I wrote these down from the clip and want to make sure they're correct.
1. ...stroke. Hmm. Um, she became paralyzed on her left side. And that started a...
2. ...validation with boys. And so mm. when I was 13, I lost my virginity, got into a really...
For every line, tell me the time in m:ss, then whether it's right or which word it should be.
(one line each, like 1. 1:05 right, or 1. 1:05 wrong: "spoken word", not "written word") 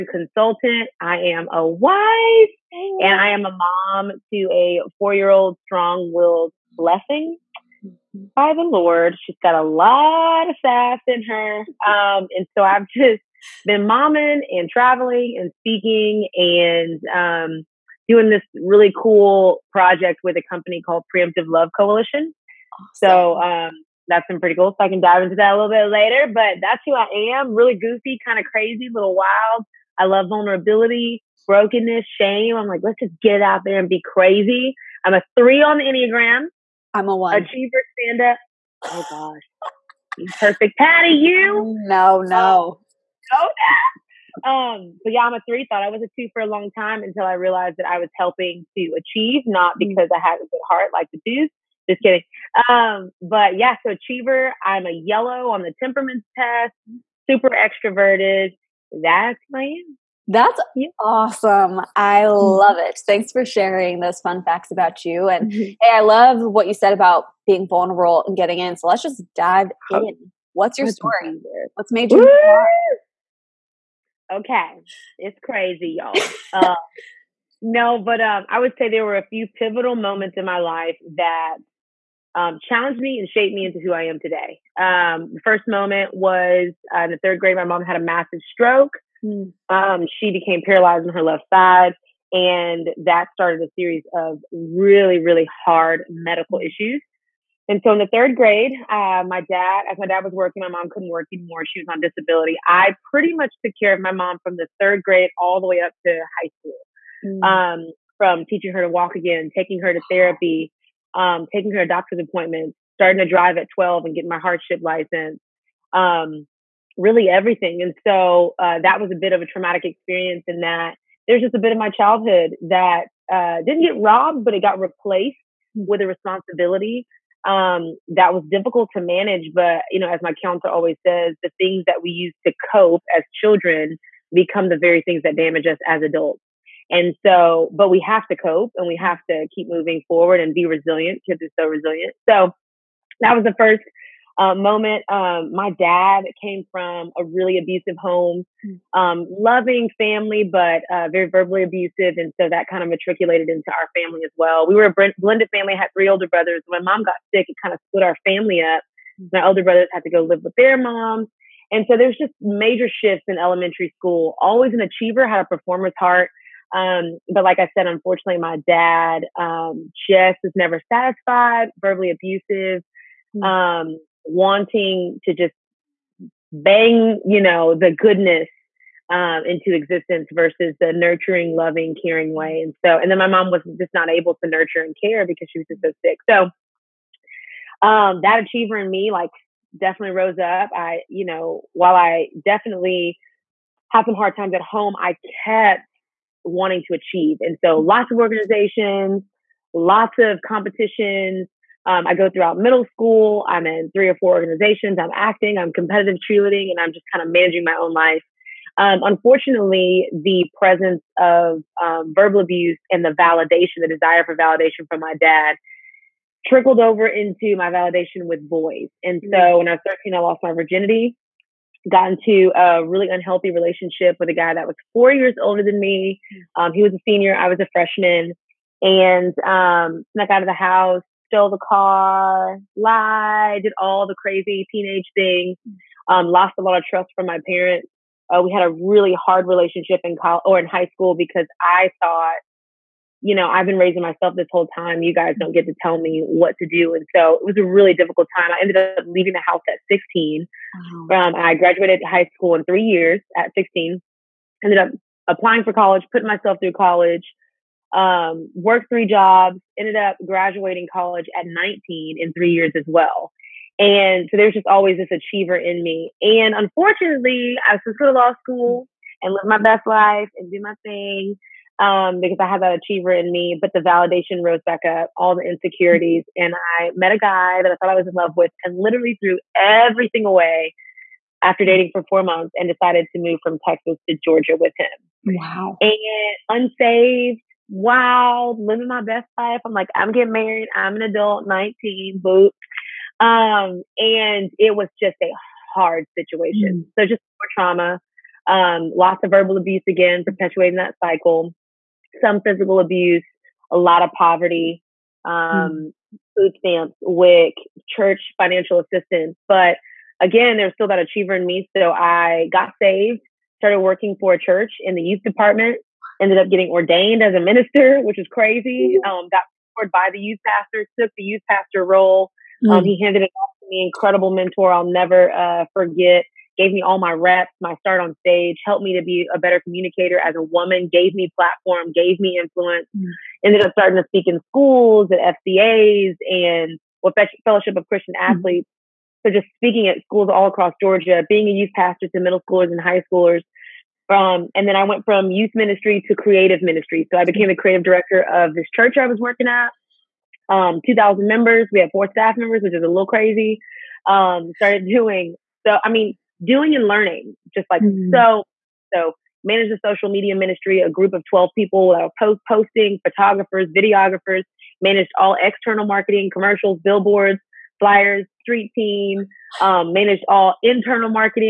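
1. 1:28 right
2. 3:37 right.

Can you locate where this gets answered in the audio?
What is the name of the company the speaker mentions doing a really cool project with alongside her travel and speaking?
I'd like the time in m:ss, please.
0:21.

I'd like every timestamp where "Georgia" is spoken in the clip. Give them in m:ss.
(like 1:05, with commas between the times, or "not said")
4:44, 5:40.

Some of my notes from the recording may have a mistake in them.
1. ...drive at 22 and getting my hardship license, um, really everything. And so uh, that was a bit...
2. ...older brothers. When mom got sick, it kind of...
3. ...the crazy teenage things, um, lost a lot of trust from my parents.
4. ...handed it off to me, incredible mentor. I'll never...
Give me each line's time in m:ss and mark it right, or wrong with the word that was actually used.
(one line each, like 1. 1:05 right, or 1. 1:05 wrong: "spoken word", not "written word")
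1. 1:53 wrong: "12", not "22"
2. 2:36 right
3. 3:54 right
4. 5:23 right.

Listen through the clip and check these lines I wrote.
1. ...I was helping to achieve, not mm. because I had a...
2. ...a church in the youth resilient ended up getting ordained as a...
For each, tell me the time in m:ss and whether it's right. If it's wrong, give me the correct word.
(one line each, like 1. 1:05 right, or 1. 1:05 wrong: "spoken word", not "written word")
1. 0:47 right
2. 5:14 wrong: "department", not "resilient".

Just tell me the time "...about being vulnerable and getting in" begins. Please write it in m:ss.
1:06.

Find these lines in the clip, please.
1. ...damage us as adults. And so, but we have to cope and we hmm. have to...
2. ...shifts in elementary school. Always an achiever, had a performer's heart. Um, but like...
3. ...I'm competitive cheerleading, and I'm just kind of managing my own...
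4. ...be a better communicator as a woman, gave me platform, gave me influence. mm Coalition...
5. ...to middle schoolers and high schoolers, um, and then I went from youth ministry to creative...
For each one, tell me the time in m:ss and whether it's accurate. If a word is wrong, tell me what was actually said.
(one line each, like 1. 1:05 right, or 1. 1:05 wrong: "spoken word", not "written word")
1. 2:15 right
2. 2:42 right
3. 3:25 right
4. 5:29 wrong: "Ended", not "Coalition"
5. 5:42 right.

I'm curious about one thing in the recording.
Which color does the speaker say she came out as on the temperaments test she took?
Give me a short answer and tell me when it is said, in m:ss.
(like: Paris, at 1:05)
Yellow, at 0:55.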